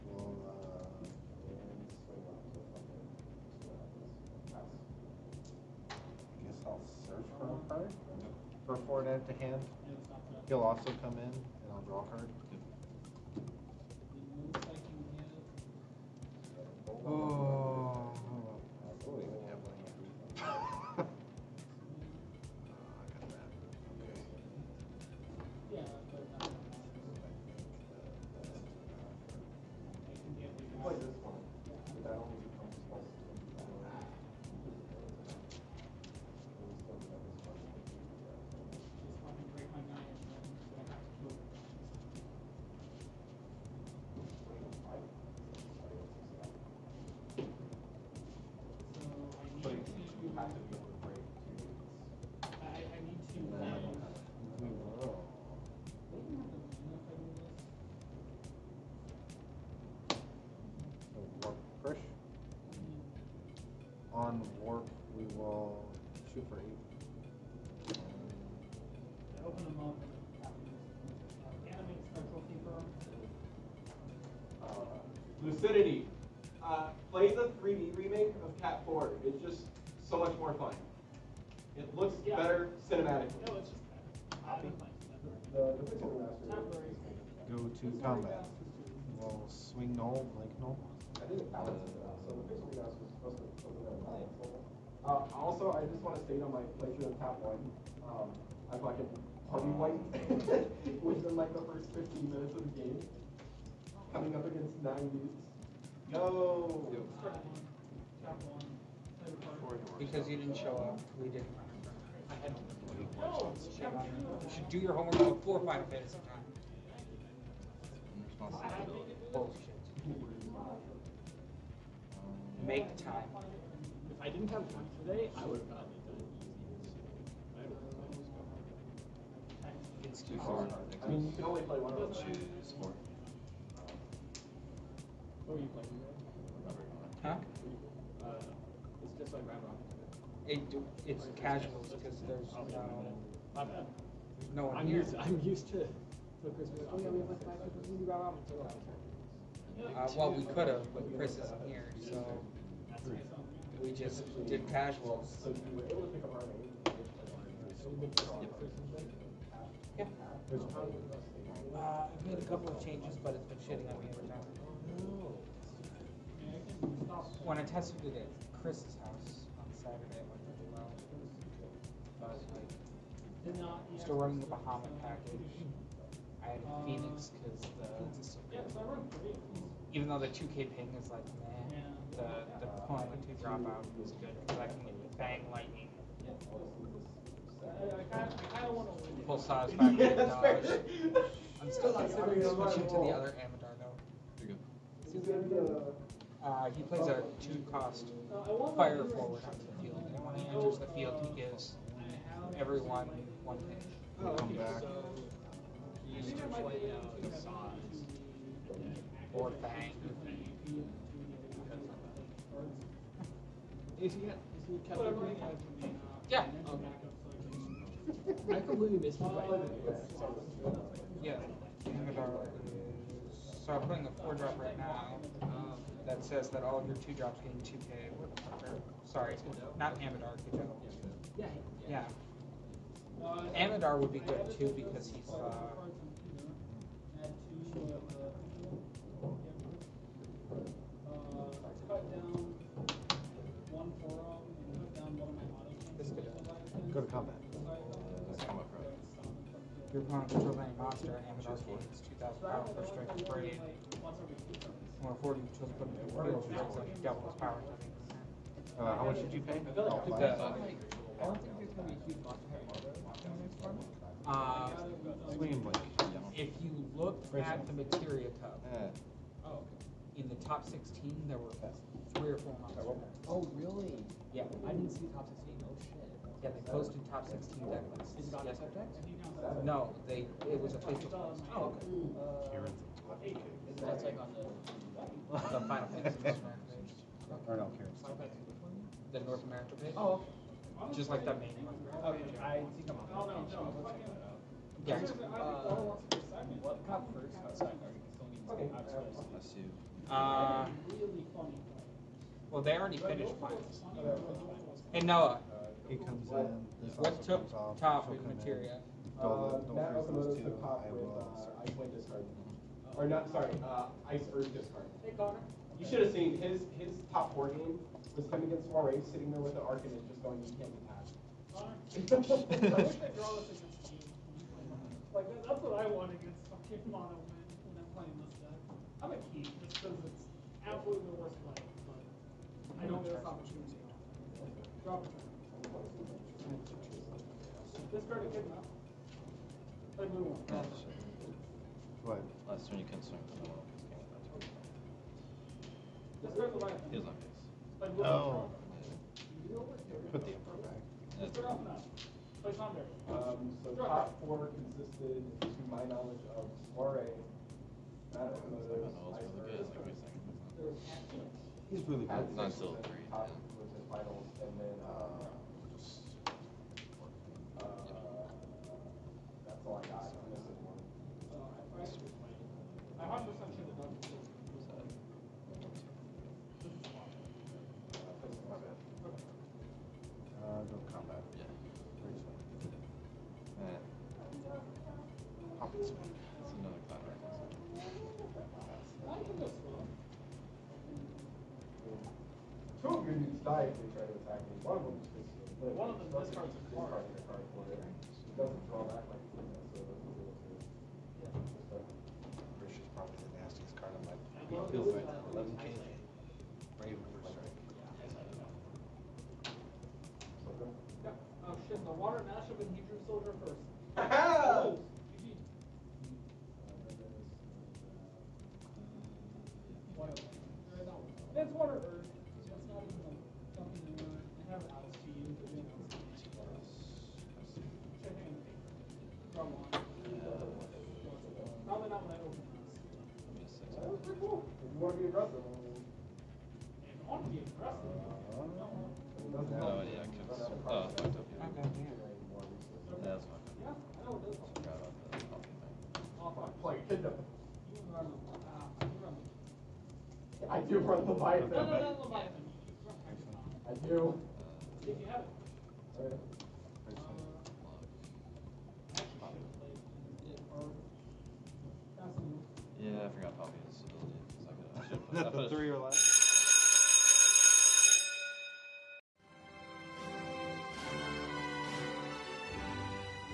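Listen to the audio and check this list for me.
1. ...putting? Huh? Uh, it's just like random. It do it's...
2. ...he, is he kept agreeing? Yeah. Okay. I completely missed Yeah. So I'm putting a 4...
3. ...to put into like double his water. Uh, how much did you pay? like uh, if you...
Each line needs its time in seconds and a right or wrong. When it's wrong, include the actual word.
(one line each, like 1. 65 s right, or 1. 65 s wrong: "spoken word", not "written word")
1. 135 s wrong: "playing", not "putting"
2. 214 s right
3. 255 s wrong: "power", not "water".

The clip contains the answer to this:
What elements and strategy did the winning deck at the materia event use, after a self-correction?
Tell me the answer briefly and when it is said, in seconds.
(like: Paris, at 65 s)
Ice Earth Discard, at 314 s.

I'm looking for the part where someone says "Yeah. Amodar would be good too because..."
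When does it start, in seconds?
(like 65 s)
231 s.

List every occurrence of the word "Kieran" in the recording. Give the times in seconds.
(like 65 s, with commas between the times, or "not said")
282 s, 287 s.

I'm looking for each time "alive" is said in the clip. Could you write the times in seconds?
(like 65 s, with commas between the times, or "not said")
346 s.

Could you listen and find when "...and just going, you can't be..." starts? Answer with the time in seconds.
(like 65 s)
319 s.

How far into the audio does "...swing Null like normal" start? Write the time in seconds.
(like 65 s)
89 s.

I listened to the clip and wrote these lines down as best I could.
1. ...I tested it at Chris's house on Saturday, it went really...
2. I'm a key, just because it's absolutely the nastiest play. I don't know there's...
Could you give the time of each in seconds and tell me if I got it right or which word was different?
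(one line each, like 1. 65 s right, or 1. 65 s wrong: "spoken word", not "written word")
1. 167 s right
2. 329 s wrong: "worst", not "nastiest".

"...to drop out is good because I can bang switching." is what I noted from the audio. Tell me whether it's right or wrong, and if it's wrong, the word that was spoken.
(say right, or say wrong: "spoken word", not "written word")
wrong: "lightning", not "switching".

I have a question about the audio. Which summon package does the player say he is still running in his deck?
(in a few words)
Bahamut.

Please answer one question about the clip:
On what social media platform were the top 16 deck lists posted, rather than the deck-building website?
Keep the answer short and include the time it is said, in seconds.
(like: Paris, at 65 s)
Facebook, at 280 s.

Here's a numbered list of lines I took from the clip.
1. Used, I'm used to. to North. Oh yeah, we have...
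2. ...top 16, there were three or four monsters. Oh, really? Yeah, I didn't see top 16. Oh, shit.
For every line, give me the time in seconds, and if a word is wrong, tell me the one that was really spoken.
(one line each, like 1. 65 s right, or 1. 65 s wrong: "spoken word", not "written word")
1. 145 s wrong: "Christmas", not "North"
2. 270 s right.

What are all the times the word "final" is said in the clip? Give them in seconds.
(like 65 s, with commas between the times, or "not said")
285 s, 303 s.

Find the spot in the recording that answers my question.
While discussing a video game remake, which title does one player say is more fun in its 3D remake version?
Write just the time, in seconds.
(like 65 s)
78 s.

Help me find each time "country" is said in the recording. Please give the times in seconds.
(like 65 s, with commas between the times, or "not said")
not said.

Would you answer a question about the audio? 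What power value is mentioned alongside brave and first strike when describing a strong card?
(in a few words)
11K.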